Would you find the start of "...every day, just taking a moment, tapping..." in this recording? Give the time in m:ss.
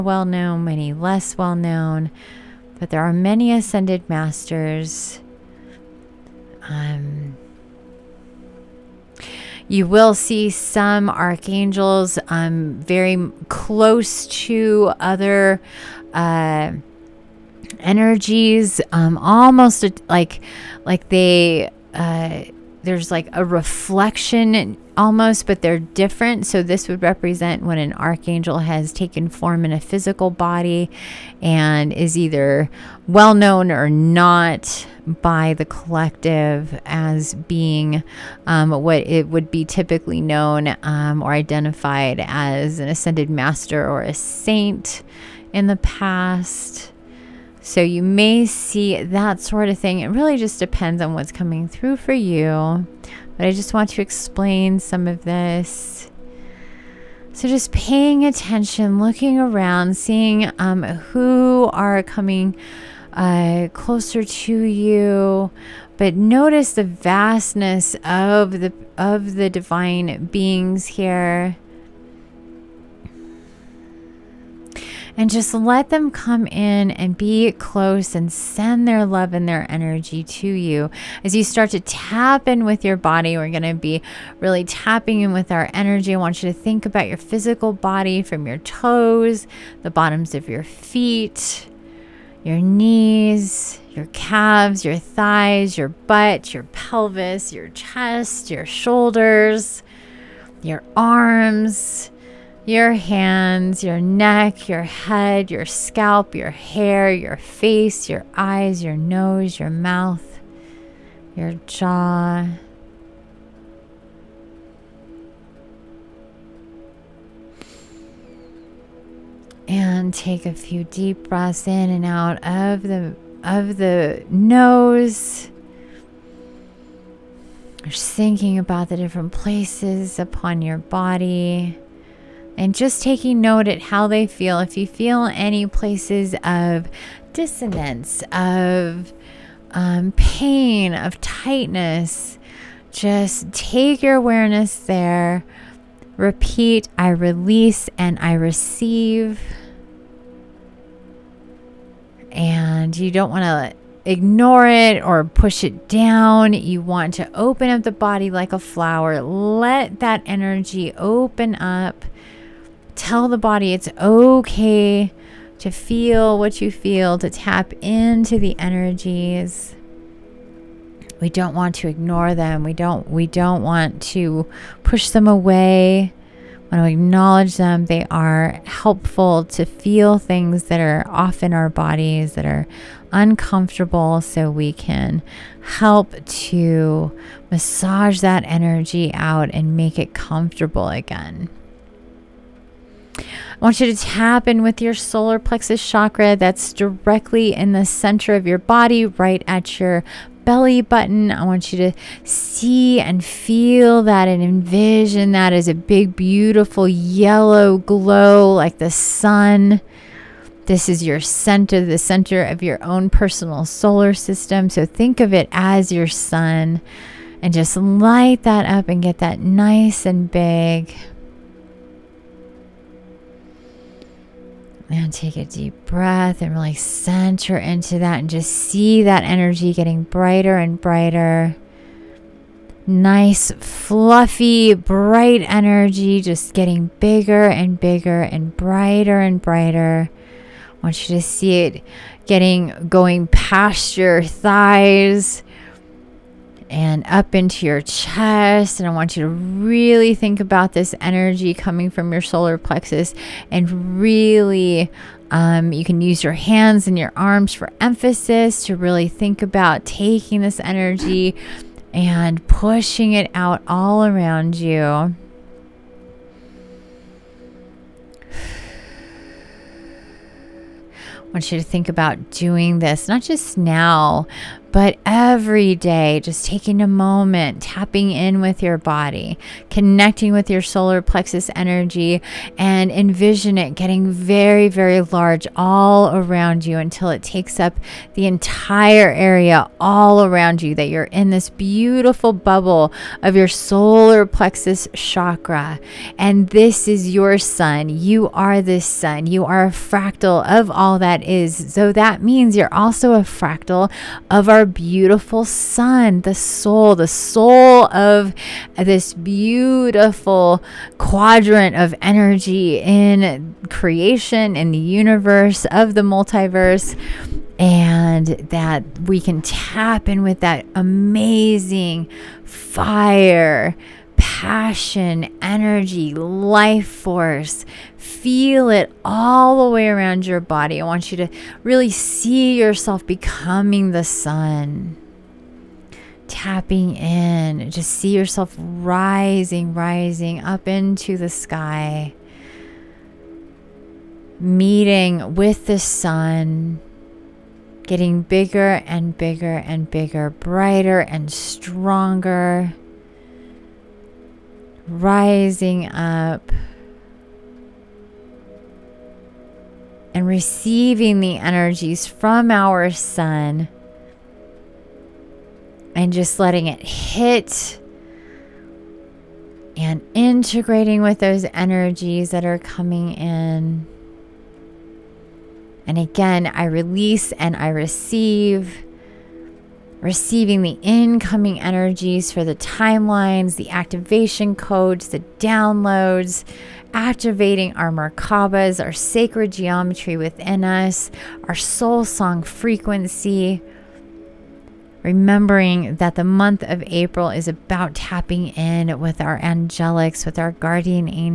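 4:35.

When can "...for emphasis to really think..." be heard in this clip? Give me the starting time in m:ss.
4:17.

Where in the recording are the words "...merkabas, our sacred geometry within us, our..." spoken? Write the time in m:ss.
6:27.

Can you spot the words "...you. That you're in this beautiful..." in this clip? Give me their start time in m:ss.
4:50.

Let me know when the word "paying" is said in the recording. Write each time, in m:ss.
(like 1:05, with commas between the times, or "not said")
0:57.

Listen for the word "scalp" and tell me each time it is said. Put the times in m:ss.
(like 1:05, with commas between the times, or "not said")
1:45.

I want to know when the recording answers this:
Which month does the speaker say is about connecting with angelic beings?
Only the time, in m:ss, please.
6:36.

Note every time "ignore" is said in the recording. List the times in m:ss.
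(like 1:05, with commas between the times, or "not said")
2:34, 2:51.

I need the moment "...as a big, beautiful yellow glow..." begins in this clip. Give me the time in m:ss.
3:25.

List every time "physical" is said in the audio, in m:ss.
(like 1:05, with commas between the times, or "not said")
0:29, 1:27.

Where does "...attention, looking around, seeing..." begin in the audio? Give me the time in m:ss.
0:58.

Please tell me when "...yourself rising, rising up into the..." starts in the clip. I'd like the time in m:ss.
5:38.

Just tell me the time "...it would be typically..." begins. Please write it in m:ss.
0:39.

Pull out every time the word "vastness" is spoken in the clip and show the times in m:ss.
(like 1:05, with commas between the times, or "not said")
1:06.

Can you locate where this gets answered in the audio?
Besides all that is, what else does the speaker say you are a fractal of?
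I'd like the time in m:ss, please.
5:04.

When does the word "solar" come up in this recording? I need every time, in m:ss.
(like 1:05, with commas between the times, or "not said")
3:14, 3:33, 4:12, 4:40, 4:53.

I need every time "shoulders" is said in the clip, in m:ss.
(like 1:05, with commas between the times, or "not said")
1:38.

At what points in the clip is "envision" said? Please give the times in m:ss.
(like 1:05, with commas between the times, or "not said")
3:24, 4:42.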